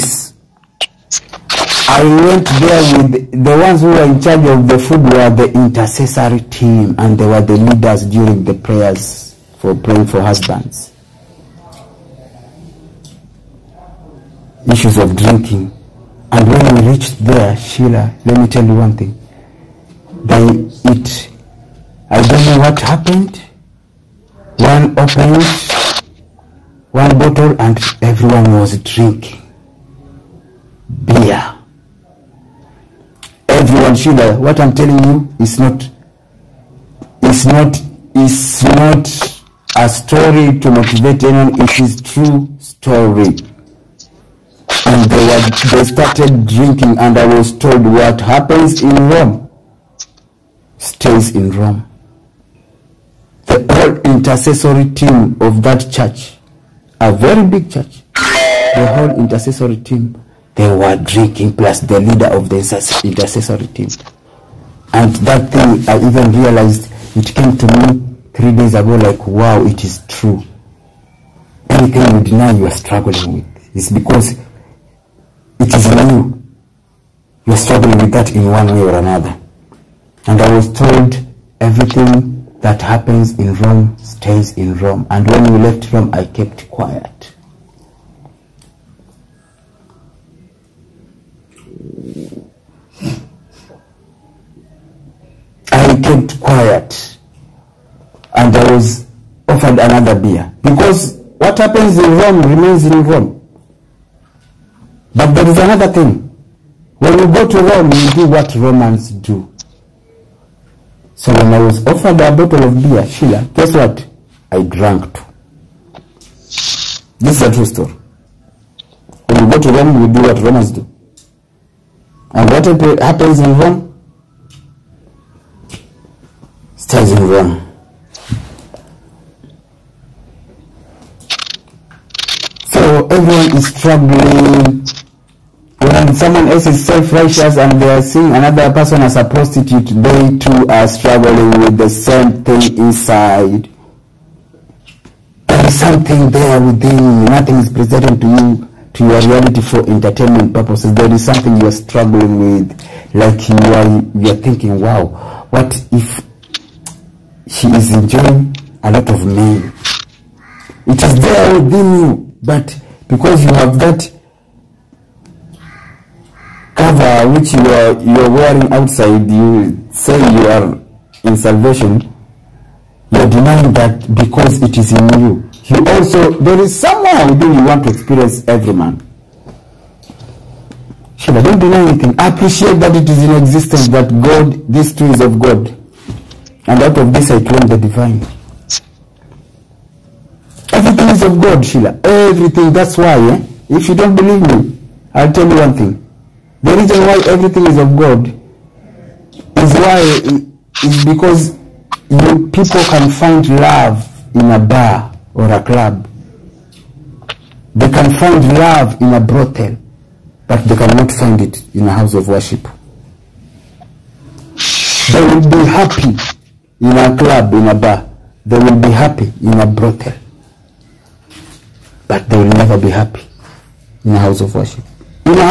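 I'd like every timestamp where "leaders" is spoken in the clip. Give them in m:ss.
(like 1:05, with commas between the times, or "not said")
0:07, 1:02.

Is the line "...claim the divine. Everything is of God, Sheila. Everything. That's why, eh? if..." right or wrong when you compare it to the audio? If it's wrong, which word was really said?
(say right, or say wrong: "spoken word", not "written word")
right.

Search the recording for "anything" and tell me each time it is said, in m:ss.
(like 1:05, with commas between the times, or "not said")
1:11, 3:01.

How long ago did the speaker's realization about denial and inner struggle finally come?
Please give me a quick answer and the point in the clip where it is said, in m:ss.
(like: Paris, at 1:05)
3 days ago, at 1:08.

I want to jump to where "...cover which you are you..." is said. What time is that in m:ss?
2:46.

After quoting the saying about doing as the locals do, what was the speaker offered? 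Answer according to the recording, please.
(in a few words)
a bottle of beer.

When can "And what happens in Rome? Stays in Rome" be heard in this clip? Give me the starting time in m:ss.
2:02.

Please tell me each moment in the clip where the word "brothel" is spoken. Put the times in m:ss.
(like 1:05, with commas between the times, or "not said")
3:29, 3:39.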